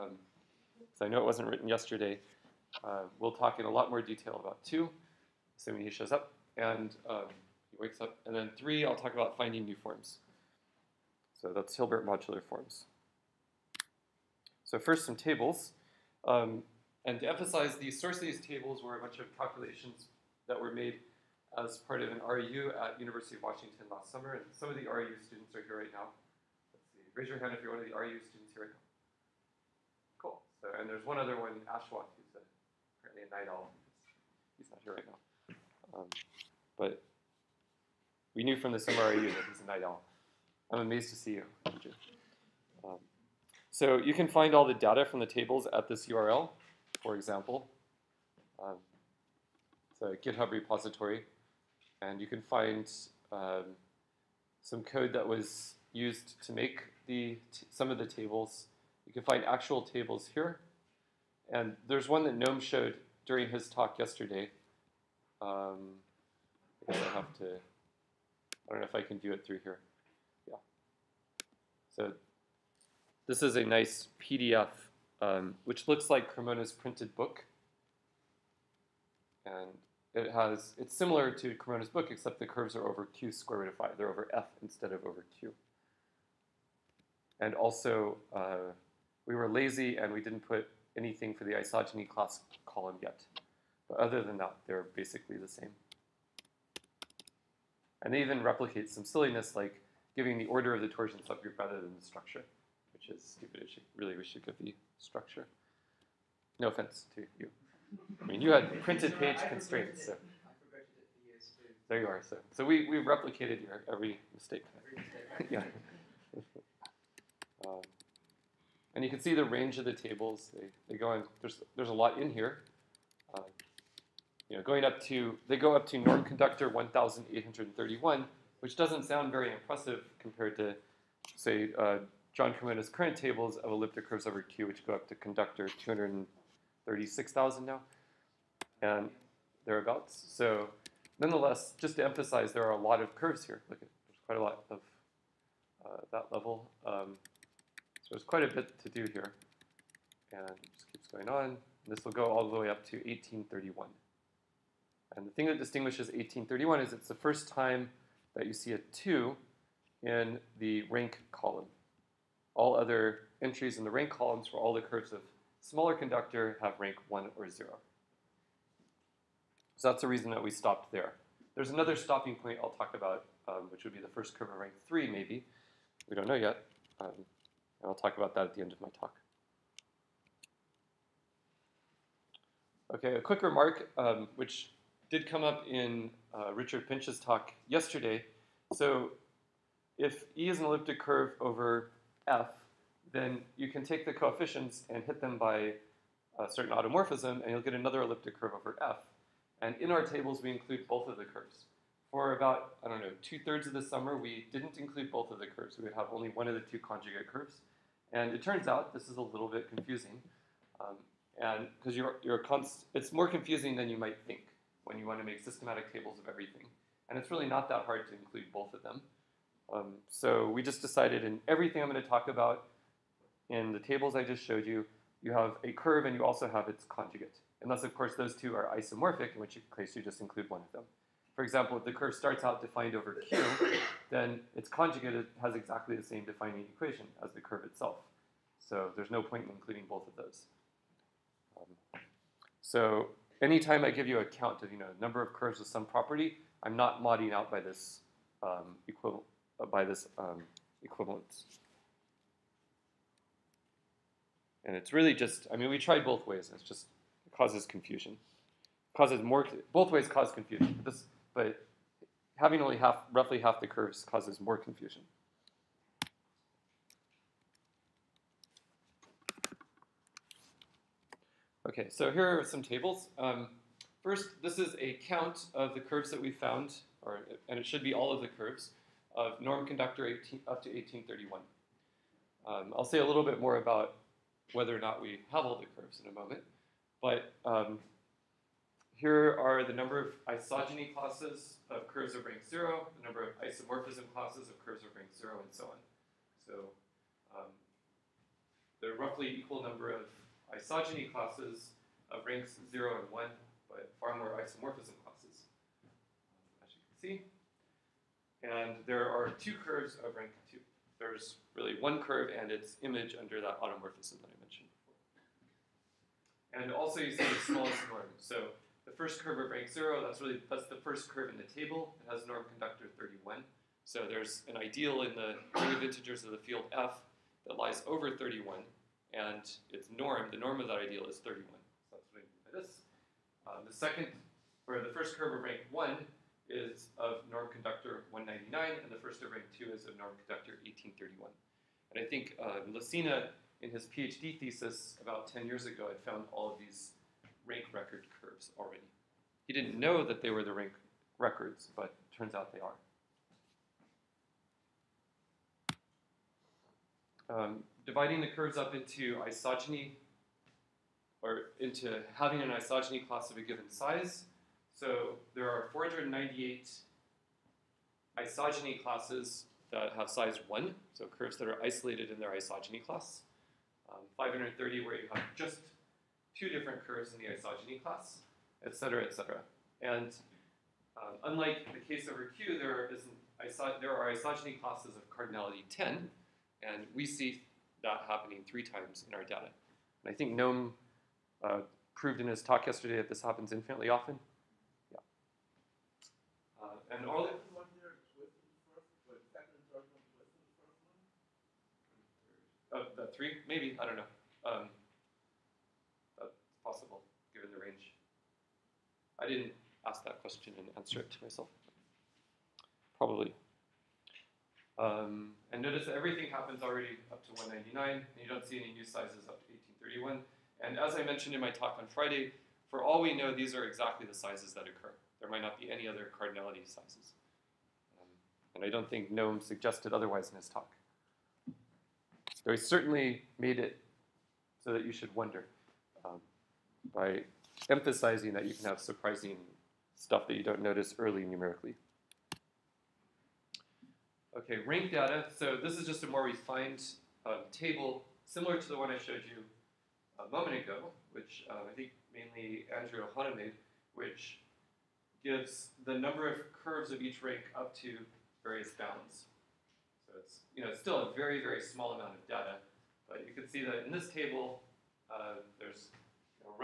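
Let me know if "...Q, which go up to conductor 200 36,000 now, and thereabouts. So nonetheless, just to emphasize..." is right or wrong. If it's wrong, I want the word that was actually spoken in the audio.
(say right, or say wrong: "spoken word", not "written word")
right.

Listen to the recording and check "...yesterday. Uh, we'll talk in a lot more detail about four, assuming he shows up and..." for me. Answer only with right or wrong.
wrong.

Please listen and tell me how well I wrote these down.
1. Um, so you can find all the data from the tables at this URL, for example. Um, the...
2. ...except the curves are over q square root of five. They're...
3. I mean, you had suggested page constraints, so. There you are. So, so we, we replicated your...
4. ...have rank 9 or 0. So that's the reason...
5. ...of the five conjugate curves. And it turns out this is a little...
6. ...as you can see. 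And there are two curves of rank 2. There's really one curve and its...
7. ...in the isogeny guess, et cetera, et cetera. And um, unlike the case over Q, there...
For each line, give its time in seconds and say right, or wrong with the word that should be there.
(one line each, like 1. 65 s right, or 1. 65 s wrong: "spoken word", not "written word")
1. 42 s right
2. 82 s right
3. 108 s wrong: "printed", not "suggested"
4. 166 s wrong: "1", not "9"
5. 206 s wrong: "two", not "five"
6. 306 s right
7. 377 s wrong: "class", not "guess".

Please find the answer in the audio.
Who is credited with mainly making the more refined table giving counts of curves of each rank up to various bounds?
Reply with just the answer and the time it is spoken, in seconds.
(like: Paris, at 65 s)
Andrew Ohana, at 452 s.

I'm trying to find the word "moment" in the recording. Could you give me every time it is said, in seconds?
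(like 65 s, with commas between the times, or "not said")
286 s, 450 s.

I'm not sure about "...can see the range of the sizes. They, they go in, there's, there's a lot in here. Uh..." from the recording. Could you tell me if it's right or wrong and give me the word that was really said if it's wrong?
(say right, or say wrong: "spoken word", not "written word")
wrong: "tables", not "sizes".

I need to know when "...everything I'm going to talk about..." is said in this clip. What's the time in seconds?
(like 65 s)
221 s.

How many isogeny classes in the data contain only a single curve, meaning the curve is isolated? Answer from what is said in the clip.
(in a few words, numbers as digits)
498.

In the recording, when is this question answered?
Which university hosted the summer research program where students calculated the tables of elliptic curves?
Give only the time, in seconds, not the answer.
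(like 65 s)
22 s.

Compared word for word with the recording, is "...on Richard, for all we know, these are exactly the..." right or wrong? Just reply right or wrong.
wrong.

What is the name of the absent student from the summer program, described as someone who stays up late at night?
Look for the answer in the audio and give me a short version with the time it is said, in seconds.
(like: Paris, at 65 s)
Ashwath, at 31 s.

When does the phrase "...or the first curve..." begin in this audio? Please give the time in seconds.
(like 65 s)
334 s.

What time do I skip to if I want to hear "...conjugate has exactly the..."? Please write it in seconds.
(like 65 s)
234 s.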